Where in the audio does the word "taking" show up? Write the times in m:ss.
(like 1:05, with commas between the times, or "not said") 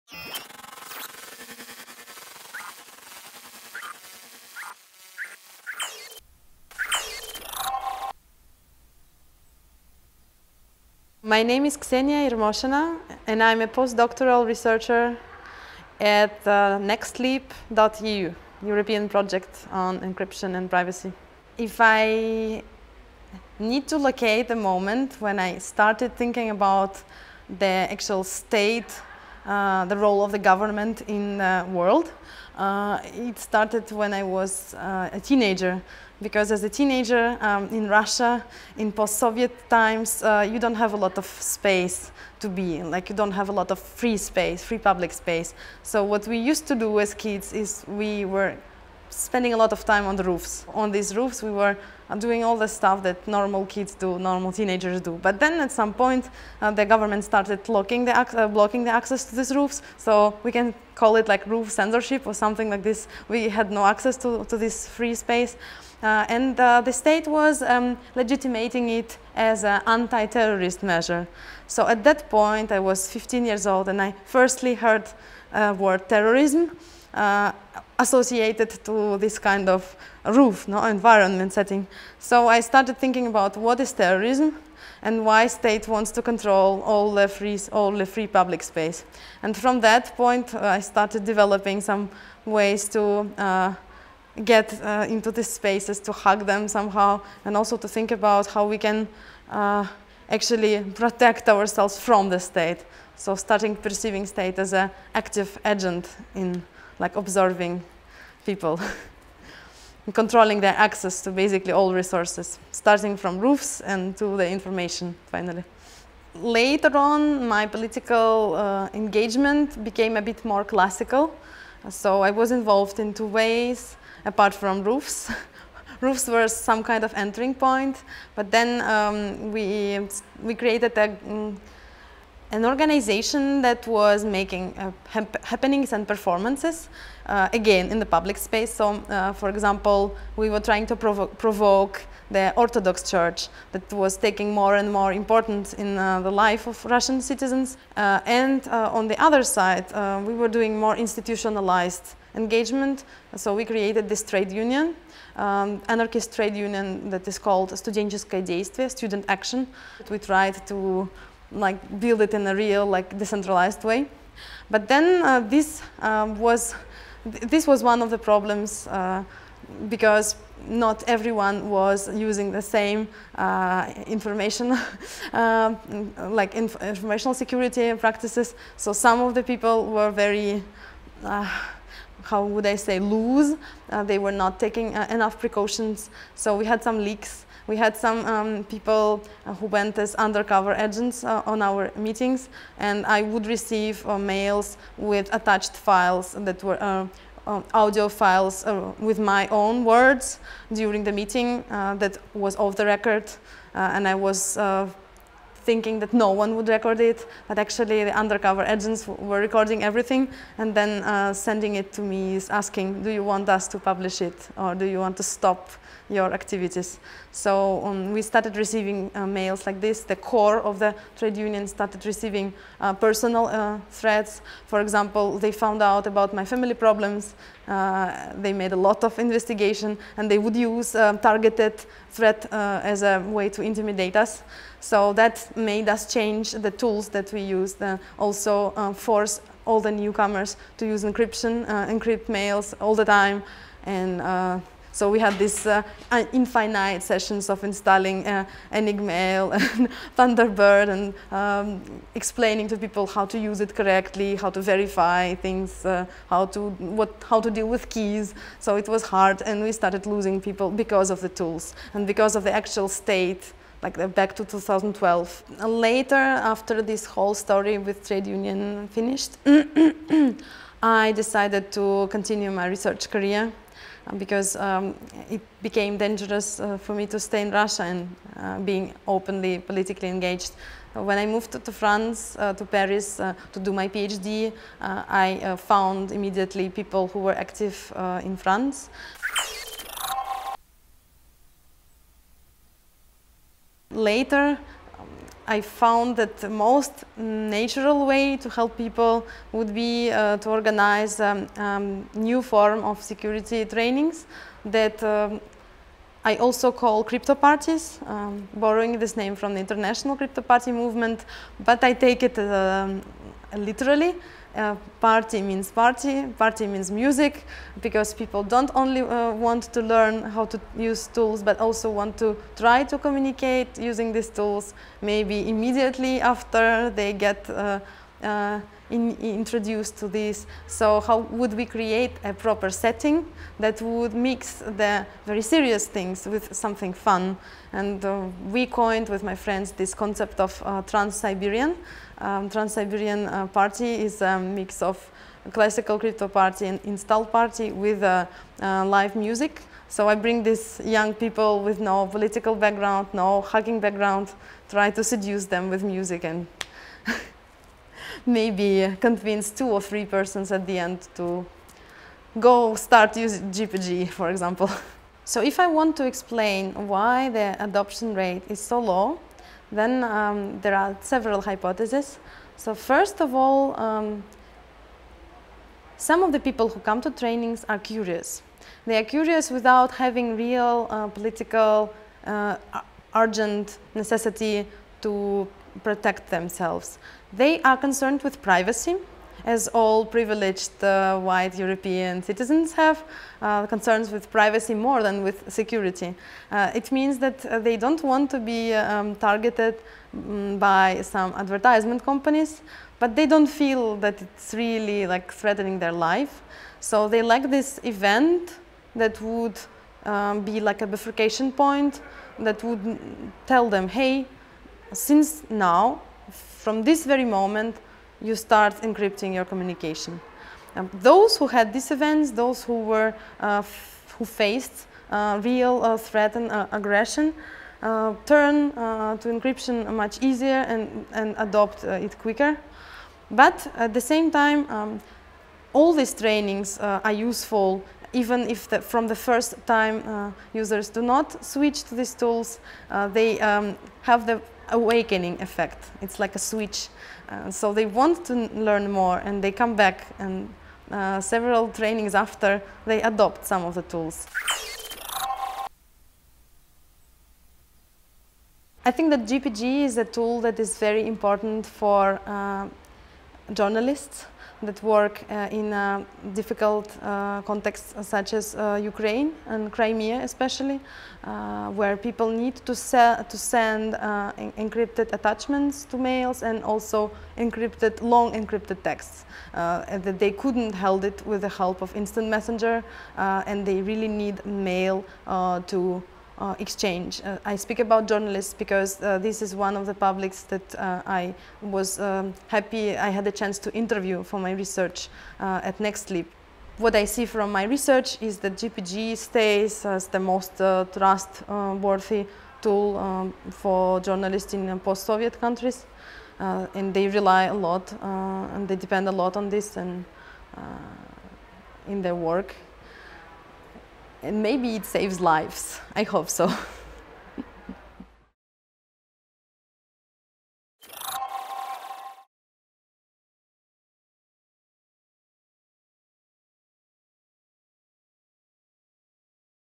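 2:24, 3:04.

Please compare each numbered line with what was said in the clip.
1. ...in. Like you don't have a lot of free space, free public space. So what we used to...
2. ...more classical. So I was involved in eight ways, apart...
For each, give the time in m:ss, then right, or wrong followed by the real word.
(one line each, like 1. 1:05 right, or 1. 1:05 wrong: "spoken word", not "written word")
1. 0:42 right
2. 2:00 wrong: "two", not "eight".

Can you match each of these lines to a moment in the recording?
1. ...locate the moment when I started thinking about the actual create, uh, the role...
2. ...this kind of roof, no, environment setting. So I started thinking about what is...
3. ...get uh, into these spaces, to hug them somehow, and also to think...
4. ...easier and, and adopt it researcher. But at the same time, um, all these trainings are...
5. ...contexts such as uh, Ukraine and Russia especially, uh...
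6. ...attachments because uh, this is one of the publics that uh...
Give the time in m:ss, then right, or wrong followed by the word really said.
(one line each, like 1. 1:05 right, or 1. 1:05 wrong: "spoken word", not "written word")
1. 0:23 wrong: "state", not "create"
2. 1:19 right
3. 1:34 right
4. 7:10 wrong: "quicker", not "researcher"
5. 7:47 wrong: "Crimea", not "Russia"
6. 8:08 wrong: "journalists", not "attachments".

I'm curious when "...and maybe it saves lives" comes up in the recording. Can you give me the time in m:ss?
8:34.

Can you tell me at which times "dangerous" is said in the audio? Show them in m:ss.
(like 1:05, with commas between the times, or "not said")
4:35.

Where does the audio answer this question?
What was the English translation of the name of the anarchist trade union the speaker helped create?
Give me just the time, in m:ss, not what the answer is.
2:38.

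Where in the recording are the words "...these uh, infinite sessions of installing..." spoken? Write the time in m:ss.
4:05.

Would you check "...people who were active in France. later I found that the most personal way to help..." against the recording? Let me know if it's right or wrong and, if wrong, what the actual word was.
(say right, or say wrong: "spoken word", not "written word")
wrong: "natural", not "personal".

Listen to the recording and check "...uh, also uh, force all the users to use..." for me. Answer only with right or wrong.
wrong.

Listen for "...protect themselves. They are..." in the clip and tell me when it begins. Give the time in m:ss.
6:25.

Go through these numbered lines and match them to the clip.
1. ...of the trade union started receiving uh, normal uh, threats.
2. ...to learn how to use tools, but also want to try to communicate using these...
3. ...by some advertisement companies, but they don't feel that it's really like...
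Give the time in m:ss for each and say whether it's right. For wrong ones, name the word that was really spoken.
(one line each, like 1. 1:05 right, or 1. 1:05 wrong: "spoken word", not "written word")
1. 3:40 wrong: "personal", not "normal"
2. 5:19 right
3. 6:40 right.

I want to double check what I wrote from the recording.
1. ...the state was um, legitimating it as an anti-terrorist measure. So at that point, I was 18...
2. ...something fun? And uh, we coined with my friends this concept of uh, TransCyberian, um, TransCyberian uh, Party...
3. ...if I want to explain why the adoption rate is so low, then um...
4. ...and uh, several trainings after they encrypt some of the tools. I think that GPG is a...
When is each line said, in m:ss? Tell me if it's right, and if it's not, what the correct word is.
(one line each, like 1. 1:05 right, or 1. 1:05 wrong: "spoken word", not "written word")
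1. 1:06 wrong: "15", not "18"
2. 5:36 right
3. 6:05 right
4. 7:30 wrong: "adopt", not "encrypt".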